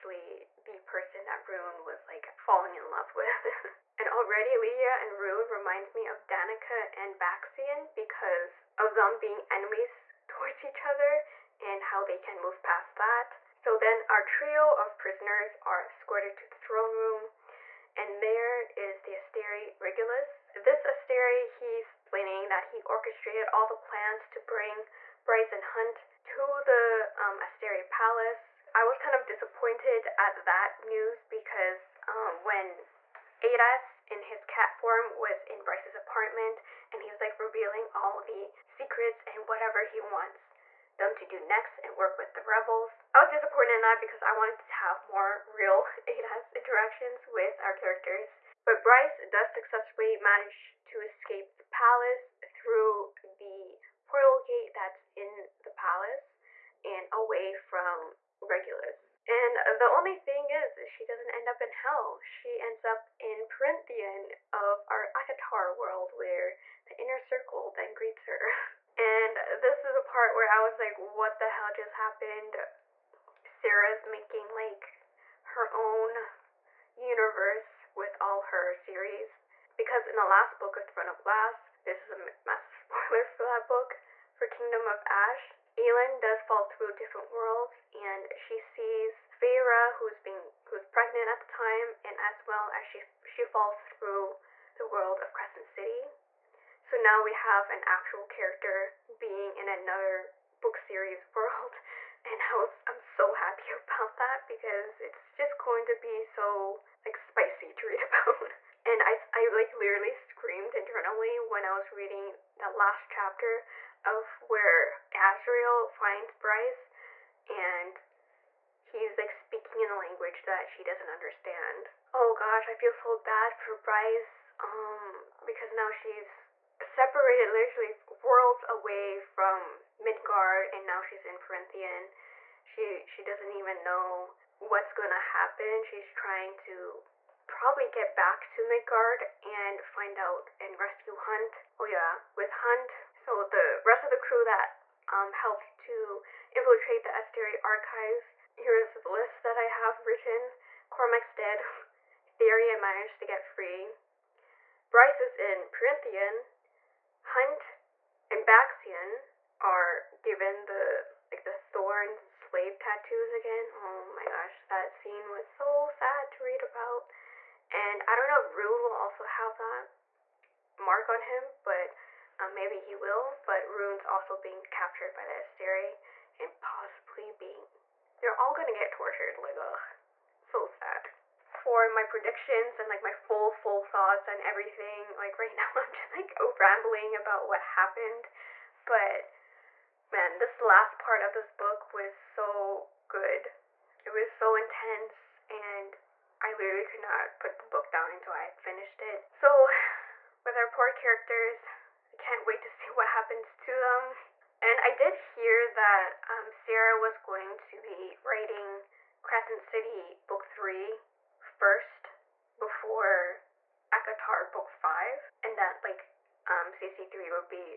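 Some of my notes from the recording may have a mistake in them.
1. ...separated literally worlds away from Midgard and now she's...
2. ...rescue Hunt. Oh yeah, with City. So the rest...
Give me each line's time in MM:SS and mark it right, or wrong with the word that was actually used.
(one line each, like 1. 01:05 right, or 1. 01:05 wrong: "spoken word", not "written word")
1. 02:06 right
2. 02:20 wrong: "Hunt", not "City".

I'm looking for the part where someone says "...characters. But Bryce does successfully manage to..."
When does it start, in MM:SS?
00:47.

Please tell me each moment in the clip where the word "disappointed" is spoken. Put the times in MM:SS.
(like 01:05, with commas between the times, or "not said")
00:29, 00:43.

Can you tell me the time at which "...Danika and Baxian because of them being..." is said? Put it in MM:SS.
00:06.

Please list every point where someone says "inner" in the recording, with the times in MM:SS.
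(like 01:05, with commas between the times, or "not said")
01:06.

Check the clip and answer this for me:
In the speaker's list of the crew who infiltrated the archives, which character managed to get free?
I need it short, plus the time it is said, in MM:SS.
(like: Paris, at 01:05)
Tharion, at 02:32.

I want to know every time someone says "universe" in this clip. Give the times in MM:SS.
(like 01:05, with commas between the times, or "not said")
01:16.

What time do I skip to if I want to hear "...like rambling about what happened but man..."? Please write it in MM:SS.
03:06.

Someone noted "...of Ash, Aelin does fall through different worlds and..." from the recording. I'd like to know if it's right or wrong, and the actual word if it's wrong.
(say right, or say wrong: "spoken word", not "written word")
right.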